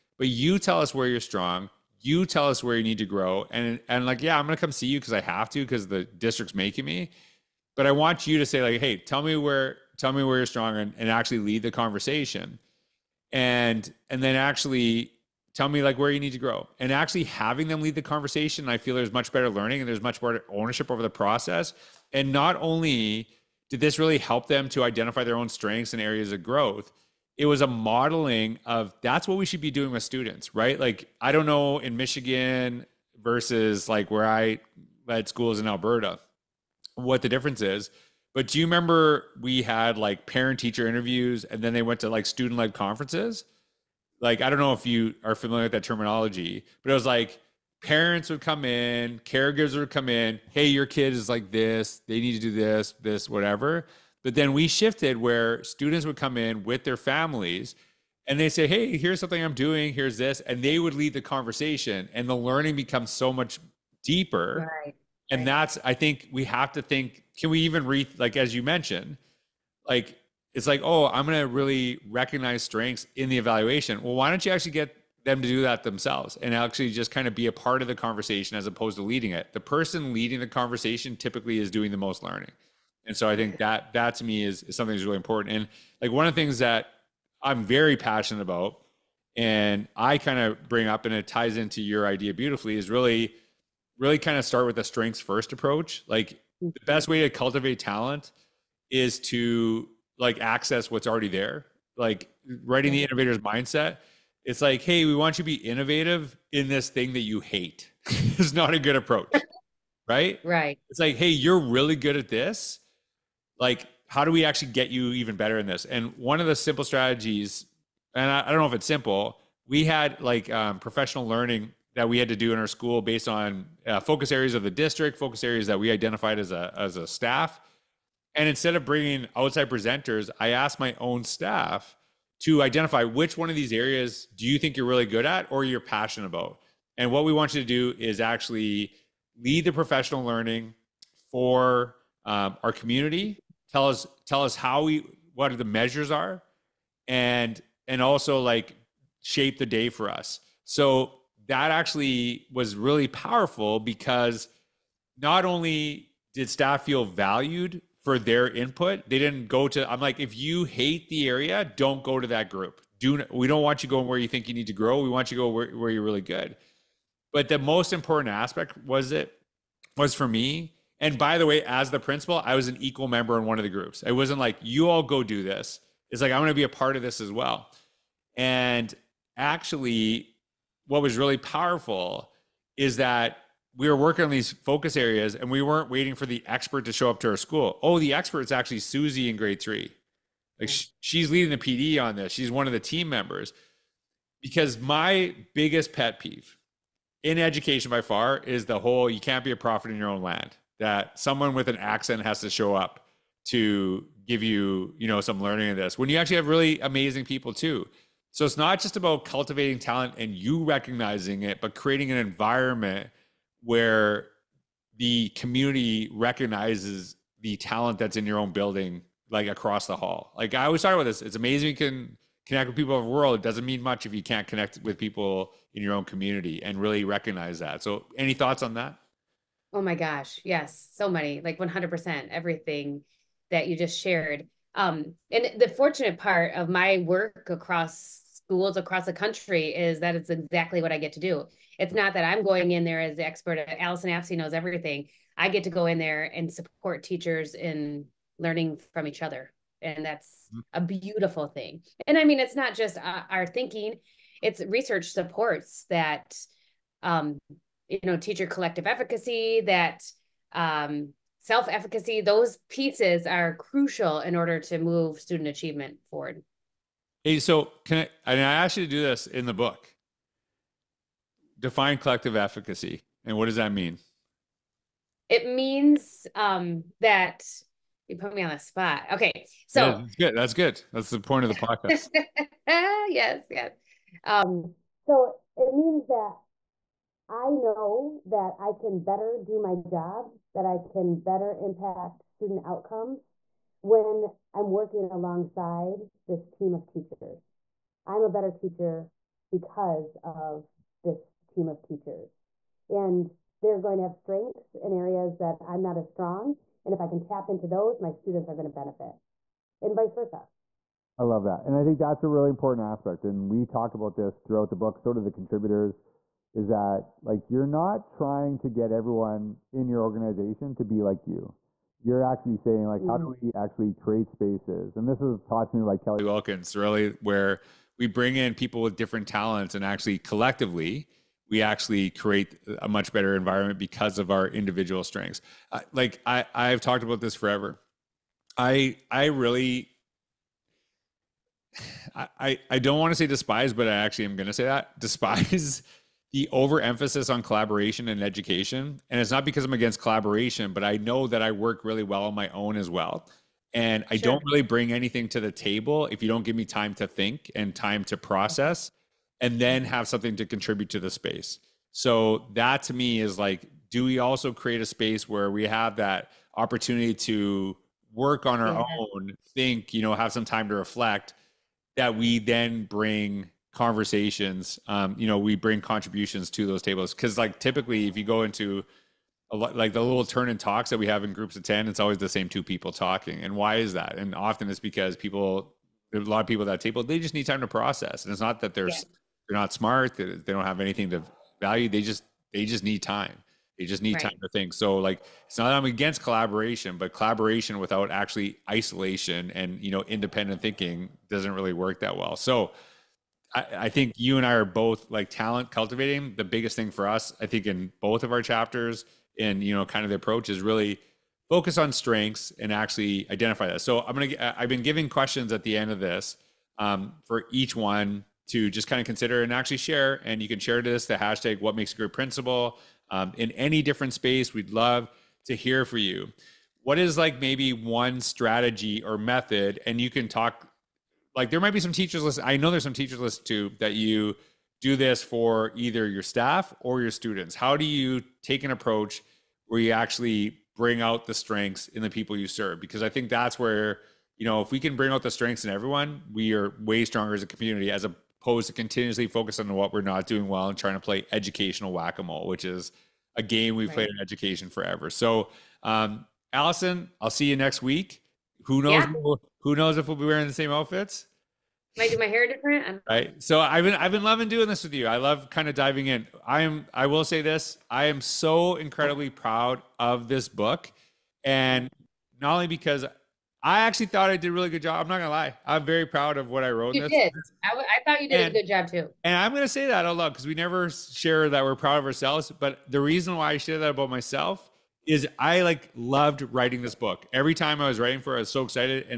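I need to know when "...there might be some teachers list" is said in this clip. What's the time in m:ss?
7:11.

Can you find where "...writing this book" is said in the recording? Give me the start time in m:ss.
8:06.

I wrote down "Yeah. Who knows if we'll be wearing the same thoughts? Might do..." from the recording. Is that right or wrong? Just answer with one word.
wrong.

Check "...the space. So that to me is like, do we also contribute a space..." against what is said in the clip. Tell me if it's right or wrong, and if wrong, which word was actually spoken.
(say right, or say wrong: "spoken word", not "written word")
wrong: "create", not "contribute".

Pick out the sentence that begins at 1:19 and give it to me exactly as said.
The person leading the conversation typically is doing the most learning.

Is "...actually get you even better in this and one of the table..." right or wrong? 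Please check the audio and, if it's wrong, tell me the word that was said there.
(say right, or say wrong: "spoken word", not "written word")
wrong: "simple", not "table".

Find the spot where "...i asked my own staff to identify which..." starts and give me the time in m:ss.
2:10.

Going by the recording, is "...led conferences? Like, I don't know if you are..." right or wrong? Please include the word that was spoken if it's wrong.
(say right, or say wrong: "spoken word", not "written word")
right.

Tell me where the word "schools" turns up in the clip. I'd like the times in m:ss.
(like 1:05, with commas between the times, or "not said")
0:35, 2:02, 3:07, 3:58.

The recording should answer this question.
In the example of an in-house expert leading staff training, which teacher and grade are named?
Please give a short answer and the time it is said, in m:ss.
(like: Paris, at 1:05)
Susie in grade 3, at 3:08.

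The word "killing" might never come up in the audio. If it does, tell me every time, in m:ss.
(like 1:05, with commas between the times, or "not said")
not said.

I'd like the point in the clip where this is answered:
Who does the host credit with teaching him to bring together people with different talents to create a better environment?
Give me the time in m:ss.
5:25.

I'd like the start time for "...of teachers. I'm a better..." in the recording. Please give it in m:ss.
4:56.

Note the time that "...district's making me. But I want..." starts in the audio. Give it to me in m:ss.
0:06.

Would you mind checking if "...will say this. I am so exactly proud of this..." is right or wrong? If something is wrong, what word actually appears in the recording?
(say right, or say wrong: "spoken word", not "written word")
wrong: "incredibly", not "exactly".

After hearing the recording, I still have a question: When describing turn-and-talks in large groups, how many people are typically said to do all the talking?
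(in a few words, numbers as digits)
2.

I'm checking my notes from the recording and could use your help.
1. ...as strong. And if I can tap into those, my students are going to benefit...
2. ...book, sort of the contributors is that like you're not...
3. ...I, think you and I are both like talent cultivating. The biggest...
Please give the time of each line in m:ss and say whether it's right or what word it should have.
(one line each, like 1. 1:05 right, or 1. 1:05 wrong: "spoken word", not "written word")
1. 5:05 right
2. 5:14 right
3. 6:43 right.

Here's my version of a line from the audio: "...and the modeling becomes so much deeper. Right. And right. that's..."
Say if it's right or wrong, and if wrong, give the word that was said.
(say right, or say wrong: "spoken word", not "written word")
wrong: "learning", not "modeling".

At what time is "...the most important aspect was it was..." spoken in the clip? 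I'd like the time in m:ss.
2:47.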